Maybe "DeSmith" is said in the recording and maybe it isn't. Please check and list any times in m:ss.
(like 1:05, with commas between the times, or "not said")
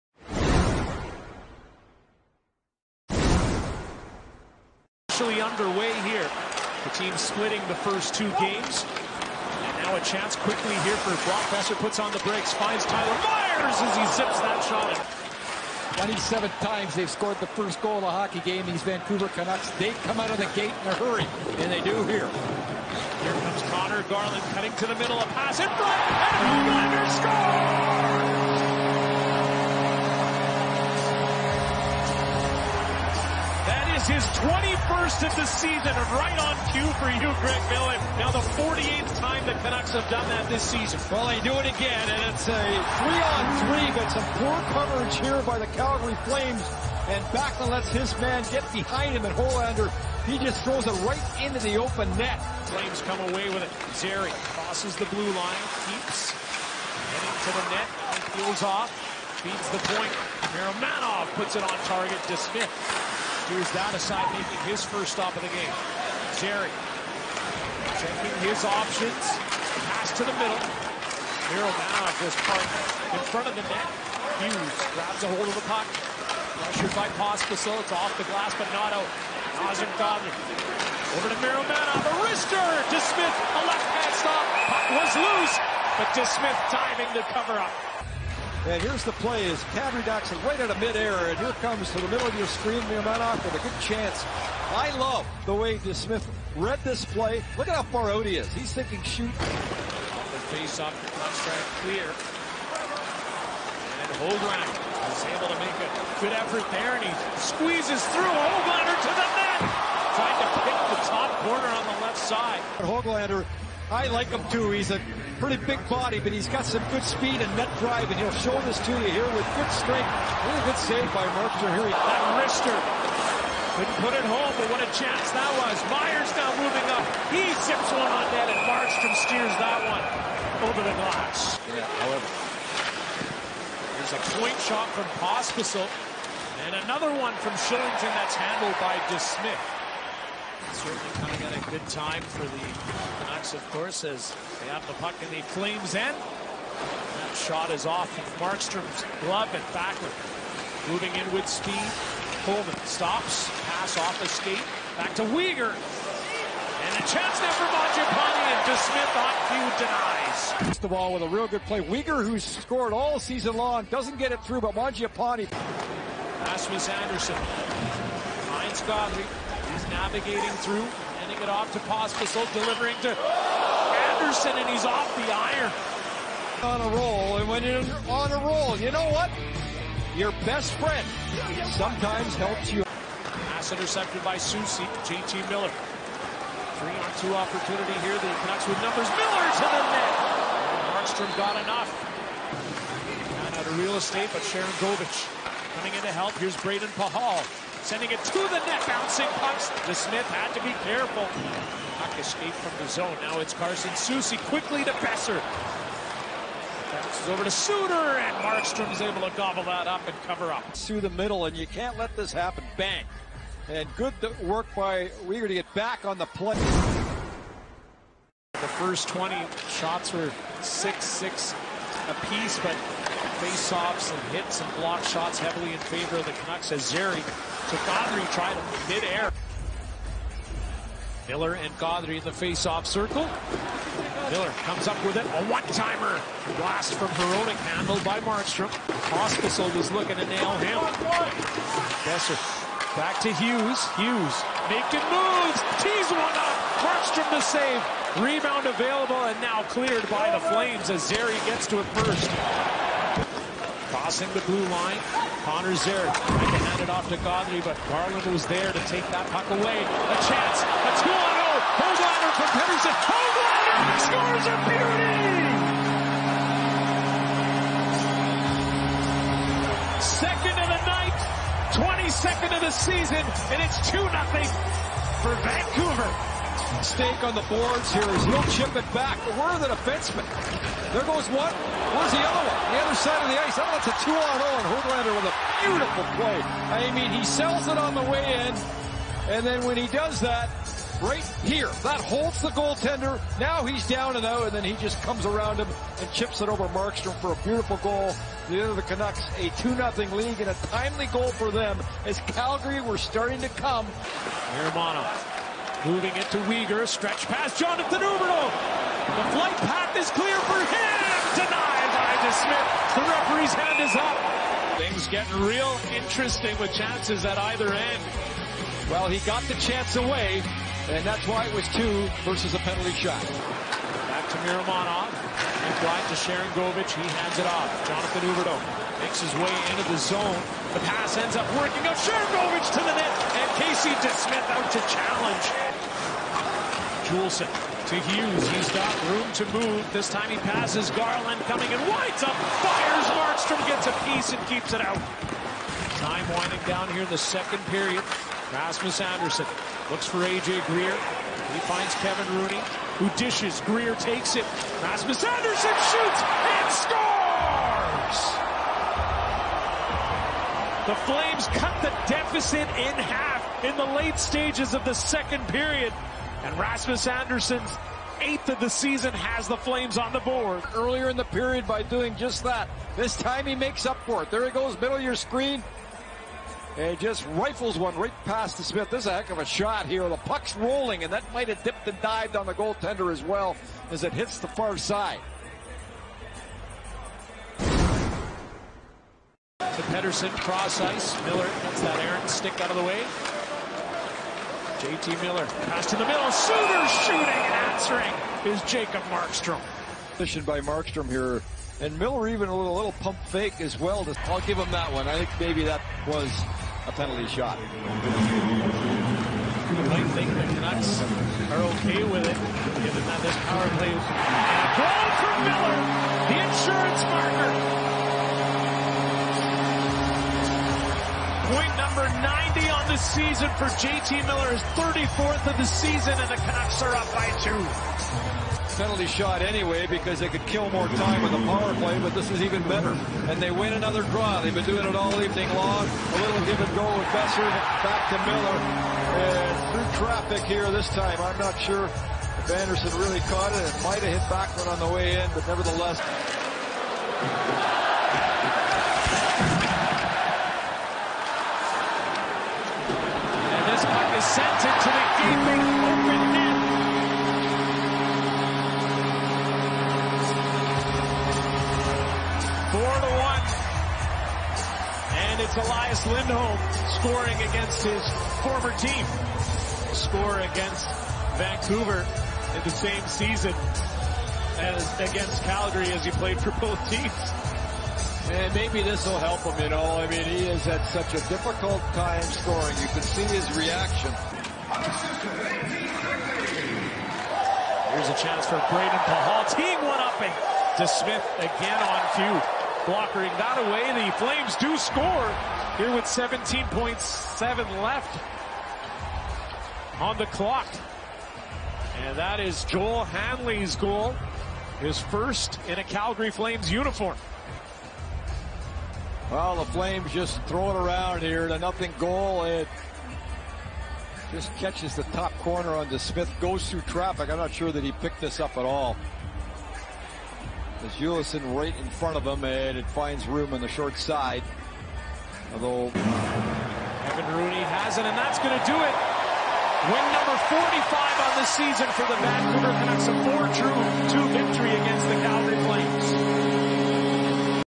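2:19, 2:38, 3:19, 5:12, 5:33, 6:18.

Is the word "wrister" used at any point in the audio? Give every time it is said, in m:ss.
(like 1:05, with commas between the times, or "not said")
1:22, 2:02.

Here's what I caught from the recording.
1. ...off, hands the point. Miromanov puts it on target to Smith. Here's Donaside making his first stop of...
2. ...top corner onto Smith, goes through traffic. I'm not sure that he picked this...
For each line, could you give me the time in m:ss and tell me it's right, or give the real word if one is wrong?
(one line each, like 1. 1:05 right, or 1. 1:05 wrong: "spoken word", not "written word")
1. 0:58 wrong: "feeds", not "hands"
2. 8:35 right.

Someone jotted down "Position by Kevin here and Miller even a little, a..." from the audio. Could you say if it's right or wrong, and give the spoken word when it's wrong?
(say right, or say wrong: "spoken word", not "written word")
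wrong: "Markstrom", not "Kevin".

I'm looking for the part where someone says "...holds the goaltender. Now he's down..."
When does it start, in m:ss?
4:52.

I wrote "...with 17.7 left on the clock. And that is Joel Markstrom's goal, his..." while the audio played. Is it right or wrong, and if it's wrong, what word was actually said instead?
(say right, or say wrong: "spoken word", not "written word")
wrong: "Hanley", not "Markstrom".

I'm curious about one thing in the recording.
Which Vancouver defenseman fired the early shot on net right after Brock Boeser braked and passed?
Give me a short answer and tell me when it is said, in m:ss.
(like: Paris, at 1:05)
Tyler Myers, at 0:12.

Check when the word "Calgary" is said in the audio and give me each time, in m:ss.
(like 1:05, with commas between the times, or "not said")
0:45, 5:02, 7:55, 8:25, 8:55.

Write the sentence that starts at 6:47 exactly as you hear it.
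I think the Canucks are okay with it, given that this power play is...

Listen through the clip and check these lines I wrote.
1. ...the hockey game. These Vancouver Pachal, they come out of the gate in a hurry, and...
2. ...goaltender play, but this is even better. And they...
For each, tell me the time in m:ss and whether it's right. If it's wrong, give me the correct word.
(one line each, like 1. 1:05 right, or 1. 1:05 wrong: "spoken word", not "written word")
1. 0:18 wrong: "Canucks", not "Pachal"
2. 7:11 wrong: "power", not "goaltender".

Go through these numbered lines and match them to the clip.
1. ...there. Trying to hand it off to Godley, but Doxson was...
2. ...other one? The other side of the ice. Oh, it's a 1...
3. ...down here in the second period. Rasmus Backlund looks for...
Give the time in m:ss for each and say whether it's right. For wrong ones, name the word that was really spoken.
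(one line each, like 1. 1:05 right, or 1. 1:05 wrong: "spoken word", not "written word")
1. 4:15 wrong: "Garland", not "Doxson"
2. 4:42 wrong: "2", not "1"
3. 5:46 wrong: "Andersson", not "Backlund".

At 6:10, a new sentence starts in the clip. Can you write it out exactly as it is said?
Earlier in the period by doing just that.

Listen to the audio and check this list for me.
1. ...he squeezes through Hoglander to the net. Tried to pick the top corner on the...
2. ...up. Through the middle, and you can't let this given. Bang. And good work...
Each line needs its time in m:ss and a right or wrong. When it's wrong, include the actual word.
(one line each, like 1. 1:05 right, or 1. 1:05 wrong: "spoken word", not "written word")
1. 1:47 right
2. 3:30 wrong: "happen", not "given".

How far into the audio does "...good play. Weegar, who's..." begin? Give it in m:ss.
2:41.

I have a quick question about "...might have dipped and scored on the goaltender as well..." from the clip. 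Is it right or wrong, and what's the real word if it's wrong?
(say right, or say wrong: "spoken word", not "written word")
wrong: "dived", not "scored".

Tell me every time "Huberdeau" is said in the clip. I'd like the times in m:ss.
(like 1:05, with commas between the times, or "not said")
5:08, 5:28.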